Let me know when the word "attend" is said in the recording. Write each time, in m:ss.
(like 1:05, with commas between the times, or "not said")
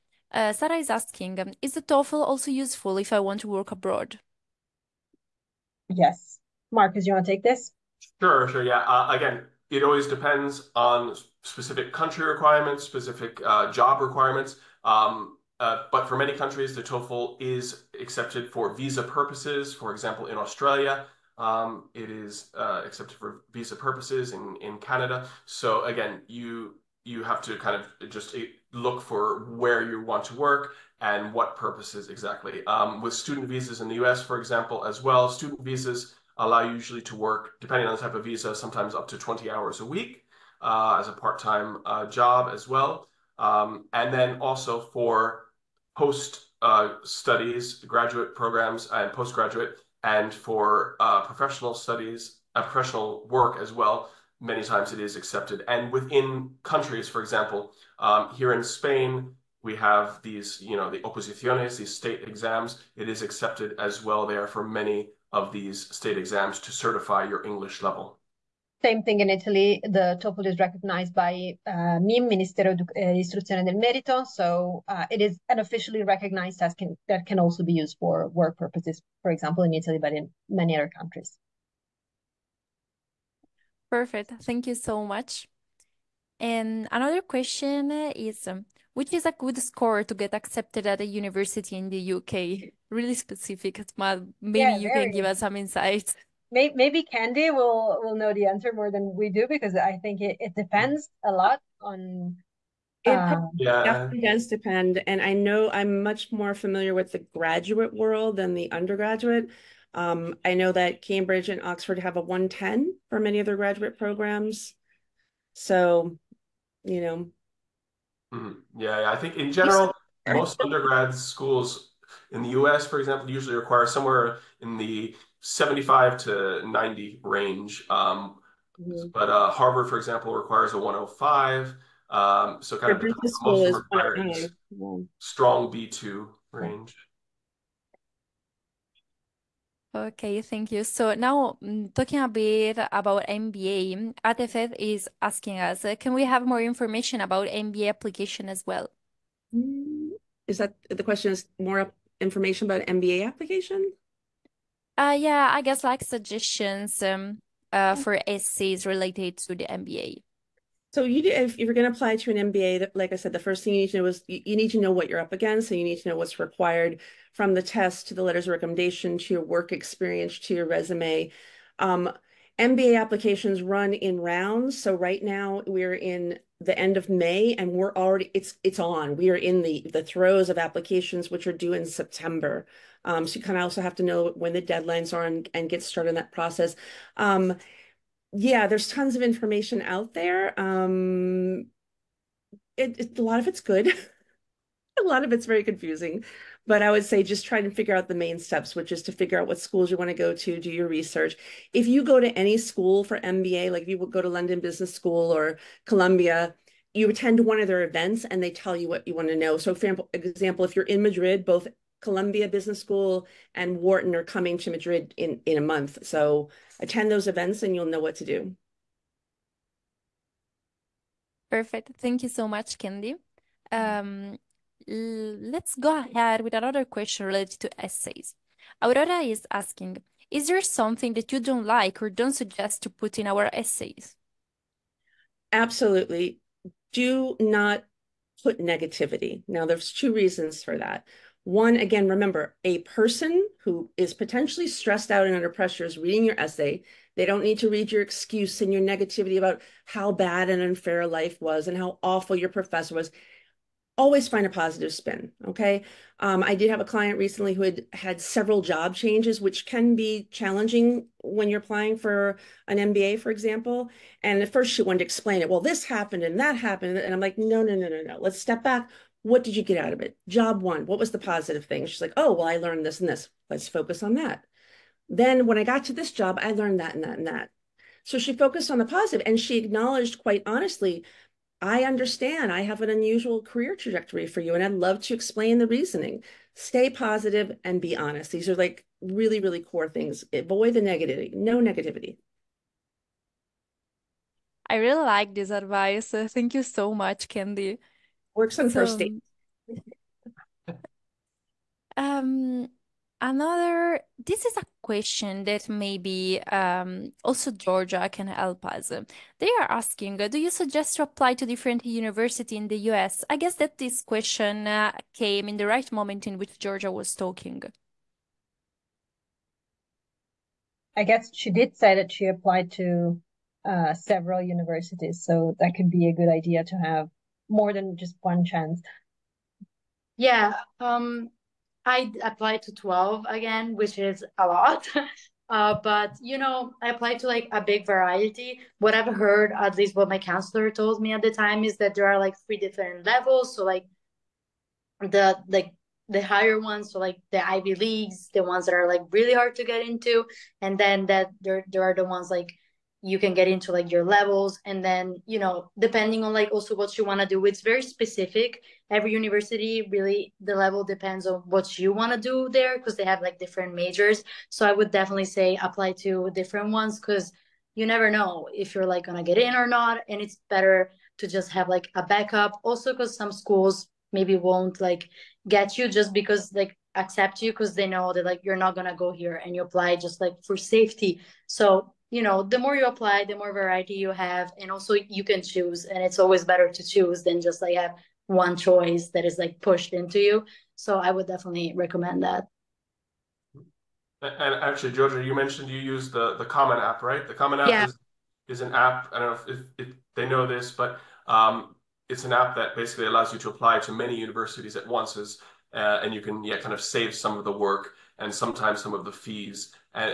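3:27, 3:36.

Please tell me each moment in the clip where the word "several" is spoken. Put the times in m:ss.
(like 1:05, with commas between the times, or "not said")
4:18, 5:23.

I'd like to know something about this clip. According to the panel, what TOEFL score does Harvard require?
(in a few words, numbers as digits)
105.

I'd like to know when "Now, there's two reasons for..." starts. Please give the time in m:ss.
3:59.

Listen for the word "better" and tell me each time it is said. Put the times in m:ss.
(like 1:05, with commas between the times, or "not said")
6:10, 6:26.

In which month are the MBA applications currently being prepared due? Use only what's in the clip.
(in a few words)
September.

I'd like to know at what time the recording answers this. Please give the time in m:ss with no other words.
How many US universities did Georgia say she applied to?
5:32.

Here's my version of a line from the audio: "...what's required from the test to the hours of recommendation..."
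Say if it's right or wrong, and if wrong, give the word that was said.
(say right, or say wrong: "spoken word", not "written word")
wrong: "letters", not "hours".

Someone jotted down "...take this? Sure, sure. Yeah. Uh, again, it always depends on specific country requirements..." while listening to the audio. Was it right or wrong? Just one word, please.
right.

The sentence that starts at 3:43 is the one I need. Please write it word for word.
Um, let's go ahead with another question related to essays.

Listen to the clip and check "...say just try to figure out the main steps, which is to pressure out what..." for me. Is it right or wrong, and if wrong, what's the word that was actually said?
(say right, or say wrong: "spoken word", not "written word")
wrong: "figure", not "pressure".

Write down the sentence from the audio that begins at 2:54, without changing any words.
So right now we're in the end of May and we're already it's it's on.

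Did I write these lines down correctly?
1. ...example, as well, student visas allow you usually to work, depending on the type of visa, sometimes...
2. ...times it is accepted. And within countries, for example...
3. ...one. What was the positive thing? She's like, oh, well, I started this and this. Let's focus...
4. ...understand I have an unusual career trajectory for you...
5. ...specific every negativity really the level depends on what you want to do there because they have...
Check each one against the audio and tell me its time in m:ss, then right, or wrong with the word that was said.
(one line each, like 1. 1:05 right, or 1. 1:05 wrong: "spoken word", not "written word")
1. 0:34 right
2. 0:54 right
3. 4:30 wrong: "learned", not "started"
4. 4:41 right
5. 5:57 wrong: "university", not "negativity".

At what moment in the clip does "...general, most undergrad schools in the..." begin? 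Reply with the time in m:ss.
1:59.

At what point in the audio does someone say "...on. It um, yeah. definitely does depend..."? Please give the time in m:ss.
1:41.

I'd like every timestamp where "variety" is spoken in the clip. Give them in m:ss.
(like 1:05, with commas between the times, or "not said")
5:37, 6:23.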